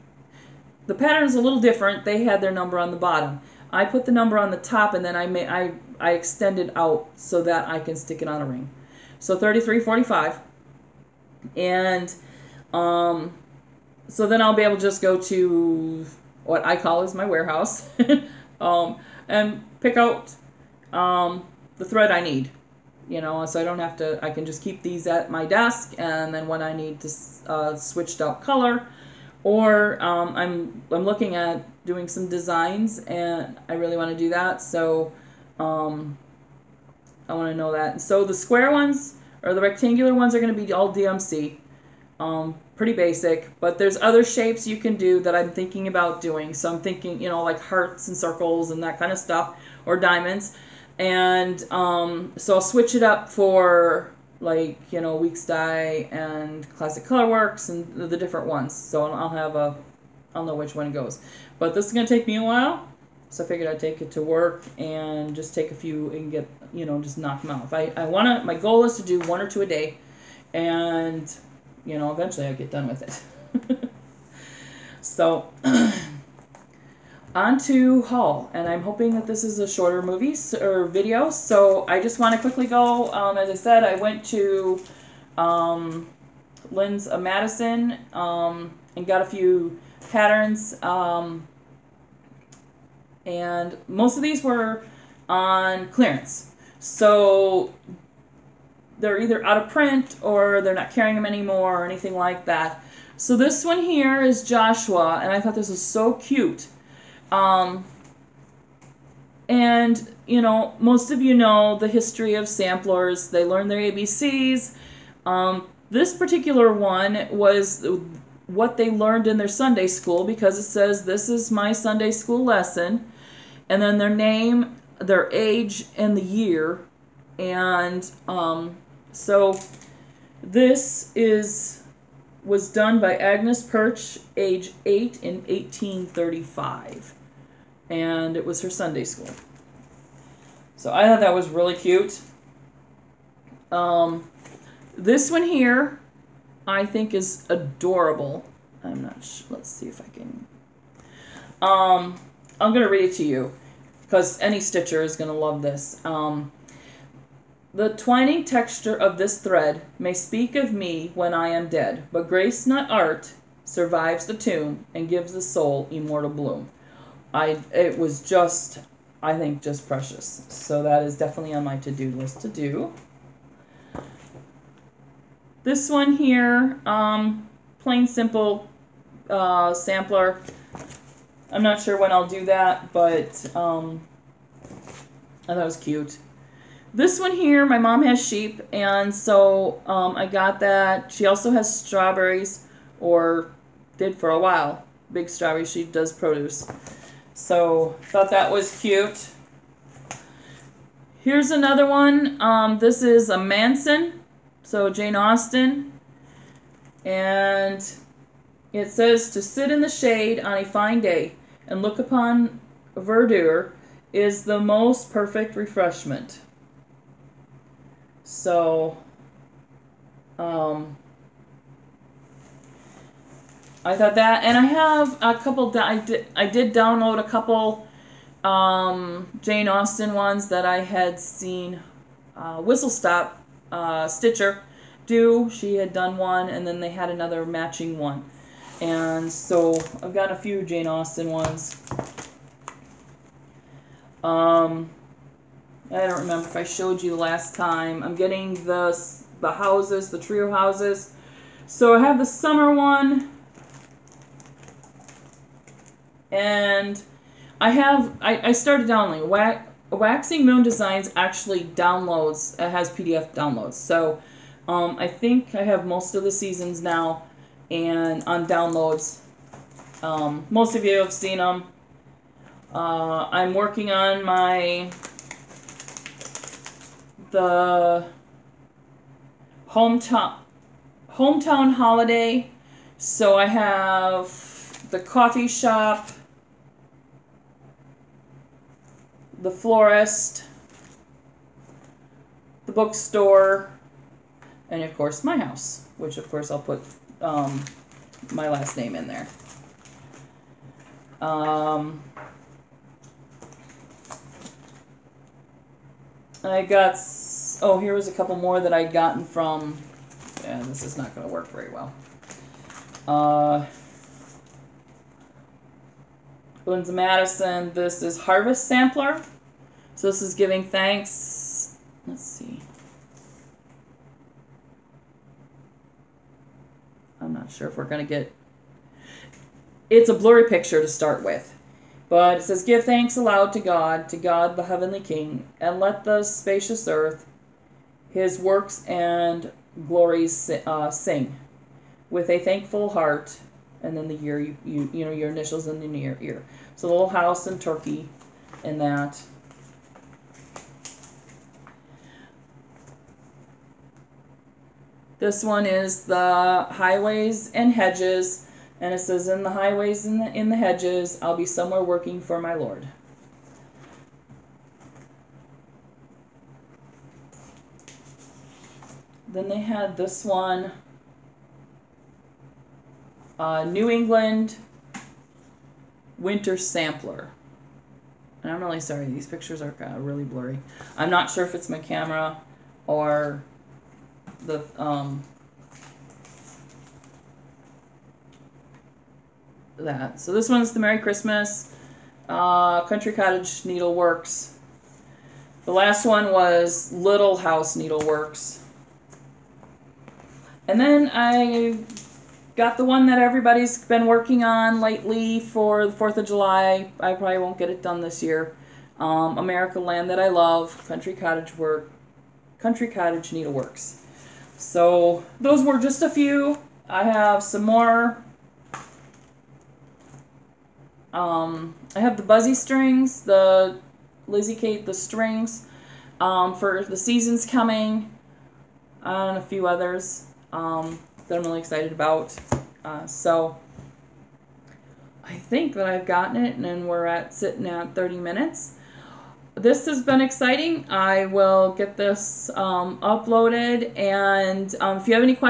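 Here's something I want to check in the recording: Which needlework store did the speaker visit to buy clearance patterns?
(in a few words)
Lynn's of Madison.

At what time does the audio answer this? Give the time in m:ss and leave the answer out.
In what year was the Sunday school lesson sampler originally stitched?
2:15.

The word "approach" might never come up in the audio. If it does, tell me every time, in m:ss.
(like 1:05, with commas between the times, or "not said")
not said.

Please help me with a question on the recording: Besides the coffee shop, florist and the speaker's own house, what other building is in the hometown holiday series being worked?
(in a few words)
the bookstore.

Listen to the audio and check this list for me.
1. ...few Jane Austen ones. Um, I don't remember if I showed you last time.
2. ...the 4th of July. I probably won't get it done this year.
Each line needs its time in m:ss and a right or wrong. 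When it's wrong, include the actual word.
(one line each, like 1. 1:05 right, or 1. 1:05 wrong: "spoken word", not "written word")
1. 4:00 right
2. 6:45 right.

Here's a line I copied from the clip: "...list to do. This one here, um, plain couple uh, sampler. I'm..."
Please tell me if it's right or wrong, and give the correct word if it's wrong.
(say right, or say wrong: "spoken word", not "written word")
wrong: "simple", not "couple".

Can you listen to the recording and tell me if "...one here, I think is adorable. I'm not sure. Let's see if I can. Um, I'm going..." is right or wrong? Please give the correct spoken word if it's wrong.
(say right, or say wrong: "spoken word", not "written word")
right.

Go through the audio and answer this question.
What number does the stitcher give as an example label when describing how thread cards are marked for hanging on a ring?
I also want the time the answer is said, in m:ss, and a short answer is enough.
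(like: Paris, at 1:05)
3345, at 0:09.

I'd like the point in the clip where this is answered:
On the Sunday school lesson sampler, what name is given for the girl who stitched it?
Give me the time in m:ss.
2:13.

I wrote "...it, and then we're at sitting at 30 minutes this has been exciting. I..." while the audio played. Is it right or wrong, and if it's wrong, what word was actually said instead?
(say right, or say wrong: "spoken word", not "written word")
right.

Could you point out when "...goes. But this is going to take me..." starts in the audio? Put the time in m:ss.
1:00.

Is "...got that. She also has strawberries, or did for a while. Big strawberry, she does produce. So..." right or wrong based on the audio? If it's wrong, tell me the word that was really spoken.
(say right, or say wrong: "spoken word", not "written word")
right.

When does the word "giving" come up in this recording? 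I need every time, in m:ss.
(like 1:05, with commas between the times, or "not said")
5:20.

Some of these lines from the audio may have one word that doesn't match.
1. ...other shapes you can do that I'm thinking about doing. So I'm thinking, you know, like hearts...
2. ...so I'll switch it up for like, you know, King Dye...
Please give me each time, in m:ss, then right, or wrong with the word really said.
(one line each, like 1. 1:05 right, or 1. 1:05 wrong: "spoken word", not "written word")
1. 0:43 right
2. 0:52 wrong: "Weeks", not "King".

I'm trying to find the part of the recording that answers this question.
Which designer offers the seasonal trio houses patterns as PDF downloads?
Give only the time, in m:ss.
4:19.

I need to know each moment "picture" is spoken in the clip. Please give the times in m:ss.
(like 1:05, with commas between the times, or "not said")
5:30, 6:19.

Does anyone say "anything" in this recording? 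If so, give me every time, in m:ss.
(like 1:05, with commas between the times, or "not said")
1:41.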